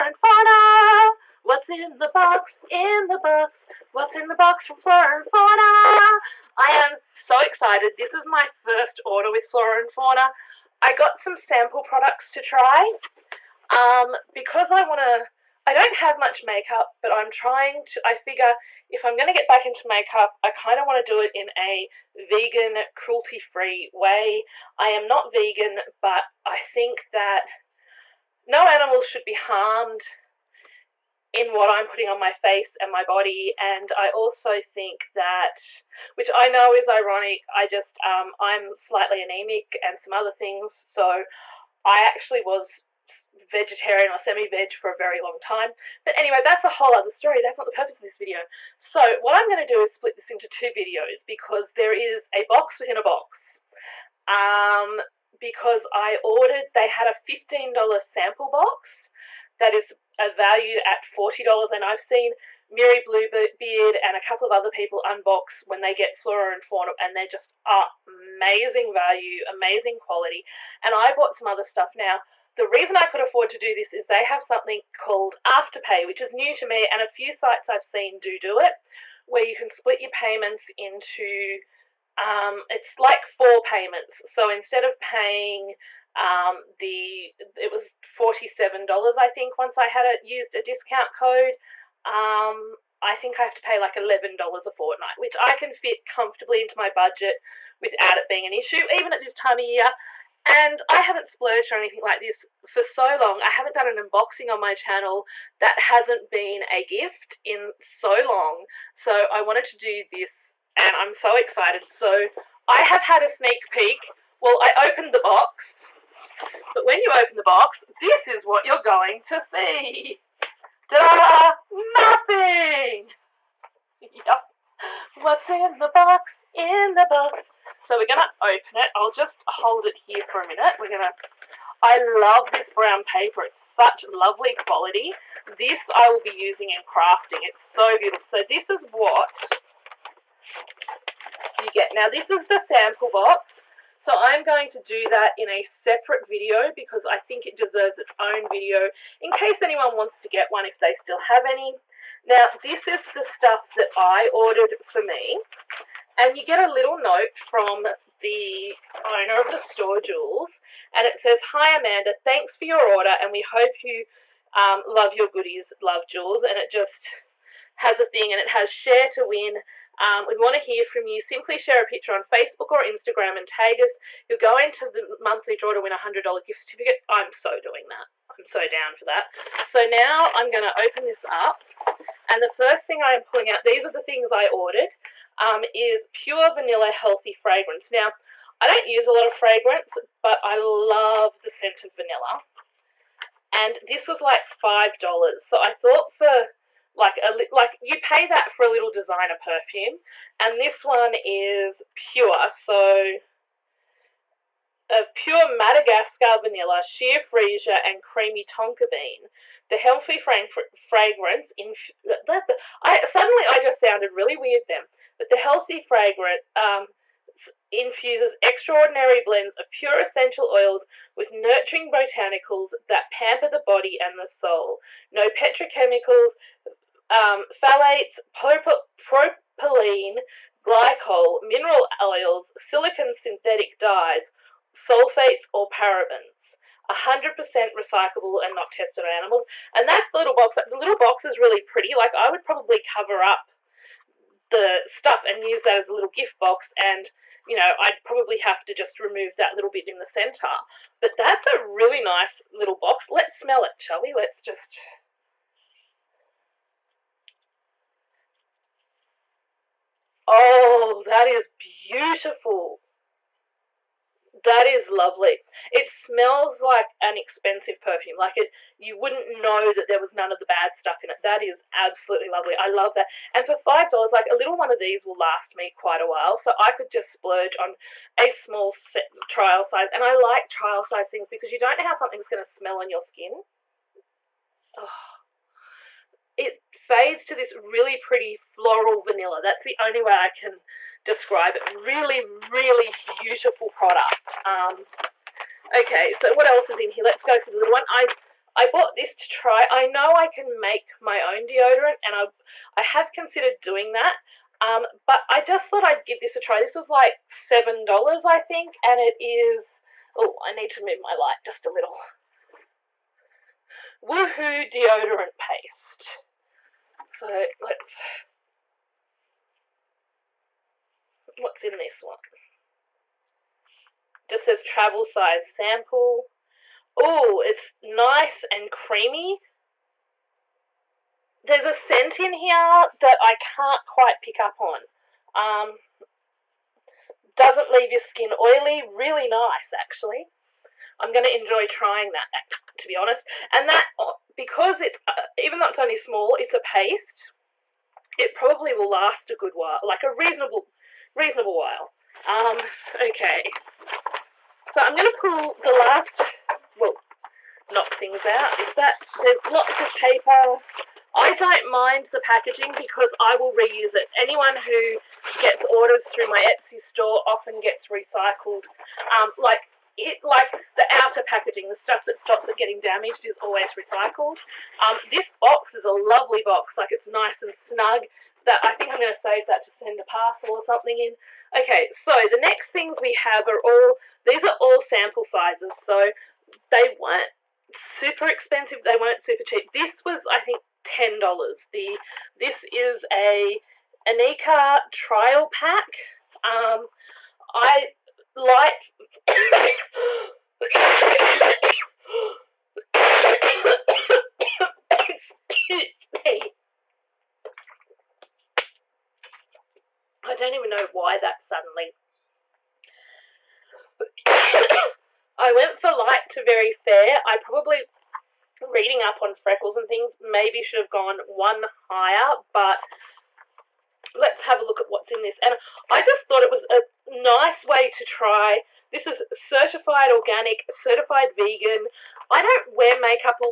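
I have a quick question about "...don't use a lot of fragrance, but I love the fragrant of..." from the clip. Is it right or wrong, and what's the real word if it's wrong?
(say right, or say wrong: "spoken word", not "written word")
wrong: "scent", not "fragrant".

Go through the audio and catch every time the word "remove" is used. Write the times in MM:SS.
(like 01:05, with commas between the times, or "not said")
04:08.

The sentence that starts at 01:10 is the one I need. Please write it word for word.
And I bought some other stuff now.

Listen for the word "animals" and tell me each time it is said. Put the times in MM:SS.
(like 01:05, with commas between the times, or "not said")
00:28, 03:59.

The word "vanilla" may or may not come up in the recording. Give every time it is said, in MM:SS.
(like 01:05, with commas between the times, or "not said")
03:06, 03:11, 03:26, 04:49.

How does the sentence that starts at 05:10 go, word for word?
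Oh, I need to move my light just a little.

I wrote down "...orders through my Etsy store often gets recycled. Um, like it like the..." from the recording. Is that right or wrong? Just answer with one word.
right.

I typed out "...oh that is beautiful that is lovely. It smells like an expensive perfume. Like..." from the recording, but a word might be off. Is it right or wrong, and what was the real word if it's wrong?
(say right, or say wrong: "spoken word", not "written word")
right.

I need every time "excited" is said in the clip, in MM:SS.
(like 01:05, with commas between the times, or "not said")
00:07, 01:51.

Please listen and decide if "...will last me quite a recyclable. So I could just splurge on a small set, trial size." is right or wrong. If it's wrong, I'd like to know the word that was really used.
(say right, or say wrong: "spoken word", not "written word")
wrong: "while", not "recyclable".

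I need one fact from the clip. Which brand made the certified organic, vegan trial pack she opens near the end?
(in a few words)
Inika.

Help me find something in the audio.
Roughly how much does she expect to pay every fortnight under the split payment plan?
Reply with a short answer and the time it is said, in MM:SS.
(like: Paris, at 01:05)
$11, at 01:33.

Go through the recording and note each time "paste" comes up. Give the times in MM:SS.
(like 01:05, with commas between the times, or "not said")
05:15, 05:46.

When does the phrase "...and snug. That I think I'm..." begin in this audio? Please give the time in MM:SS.
06:17.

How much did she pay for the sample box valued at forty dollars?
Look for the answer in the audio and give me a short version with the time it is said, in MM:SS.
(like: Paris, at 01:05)
$15, at 00:57.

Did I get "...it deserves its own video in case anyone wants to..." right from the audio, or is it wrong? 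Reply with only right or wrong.
right.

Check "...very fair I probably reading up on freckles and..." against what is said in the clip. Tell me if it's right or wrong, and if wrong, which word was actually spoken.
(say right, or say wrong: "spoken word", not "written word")
right.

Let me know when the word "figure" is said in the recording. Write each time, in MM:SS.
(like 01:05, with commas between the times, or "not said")
00:18.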